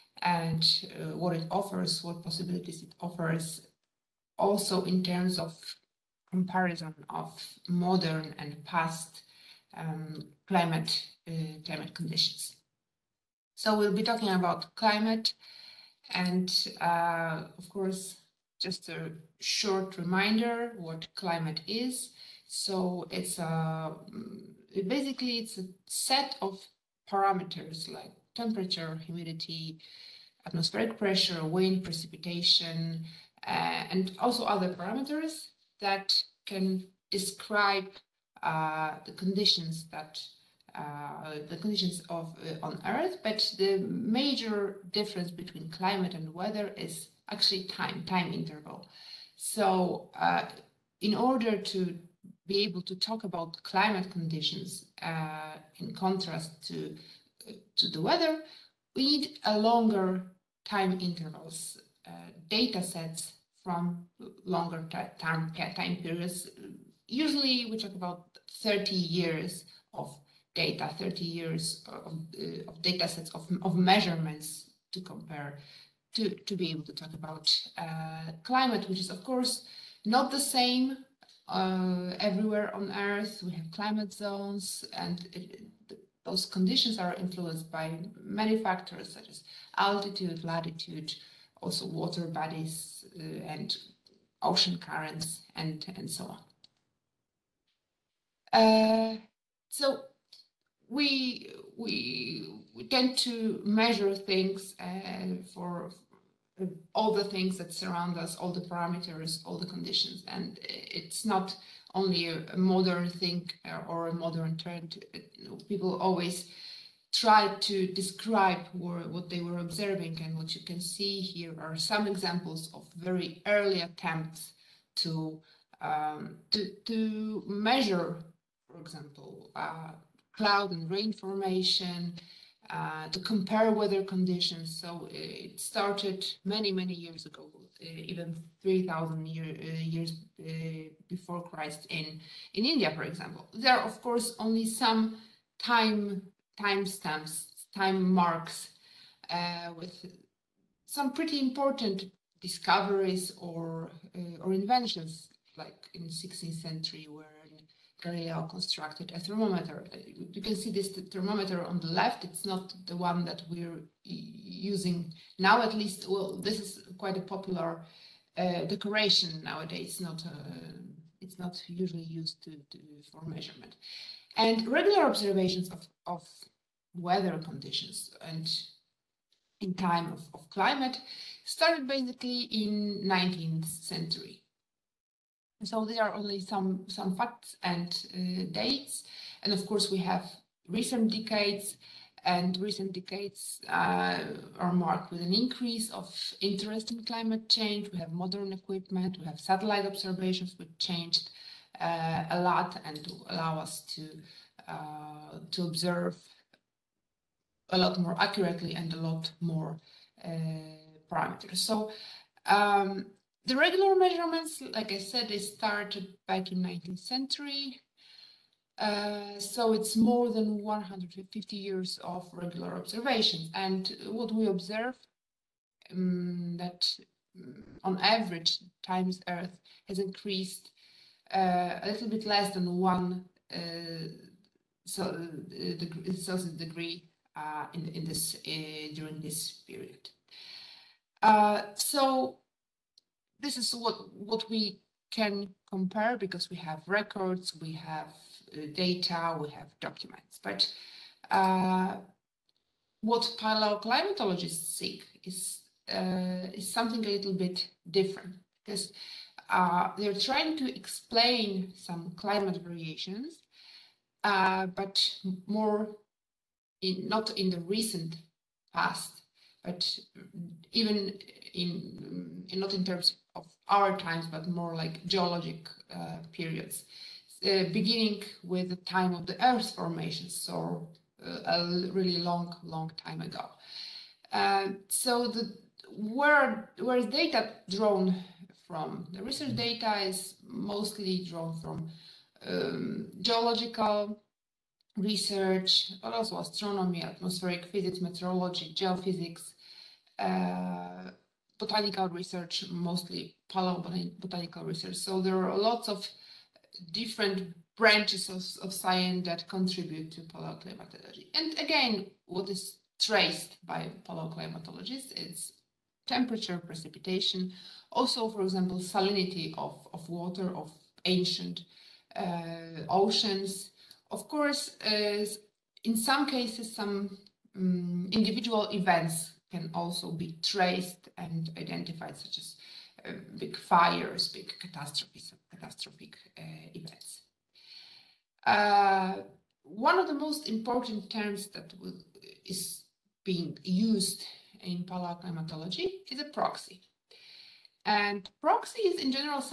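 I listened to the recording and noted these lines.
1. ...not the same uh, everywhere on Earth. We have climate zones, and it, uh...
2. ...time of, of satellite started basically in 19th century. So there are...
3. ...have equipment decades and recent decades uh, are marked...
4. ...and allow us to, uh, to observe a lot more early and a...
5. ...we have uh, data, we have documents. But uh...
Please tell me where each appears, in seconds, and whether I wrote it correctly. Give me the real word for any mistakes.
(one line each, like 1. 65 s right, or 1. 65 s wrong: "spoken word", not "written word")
1. 80 s right
2. 179 s wrong: "climate", not "satellite"
3. 189 s wrong: "recent", not "equipment"
4. 202 s wrong: "accurately", not "early"
5. 247 s right.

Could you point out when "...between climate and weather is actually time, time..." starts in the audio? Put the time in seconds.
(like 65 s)
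45 s.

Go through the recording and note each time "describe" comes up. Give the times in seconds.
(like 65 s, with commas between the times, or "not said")
37 s, 117 s.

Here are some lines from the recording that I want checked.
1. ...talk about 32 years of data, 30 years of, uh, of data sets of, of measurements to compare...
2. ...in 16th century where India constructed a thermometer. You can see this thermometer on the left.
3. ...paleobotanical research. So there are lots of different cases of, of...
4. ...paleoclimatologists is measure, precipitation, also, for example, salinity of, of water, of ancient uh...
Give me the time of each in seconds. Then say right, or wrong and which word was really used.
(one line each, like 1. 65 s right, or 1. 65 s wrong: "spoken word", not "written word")
1. 67 s wrong: "30", not "32"
2. 155 s wrong: "Galileo", not "India"
3. 303 s wrong: "branches", not "cases"
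4. 314 s wrong: "temperature", not "measure".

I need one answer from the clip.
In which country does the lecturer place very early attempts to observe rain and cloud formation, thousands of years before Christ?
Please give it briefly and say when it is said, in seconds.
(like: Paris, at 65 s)
India, at 142 s.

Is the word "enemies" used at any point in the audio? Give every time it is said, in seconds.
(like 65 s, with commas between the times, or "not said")
not said.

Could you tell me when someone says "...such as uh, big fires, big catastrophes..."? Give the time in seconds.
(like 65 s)
332 s.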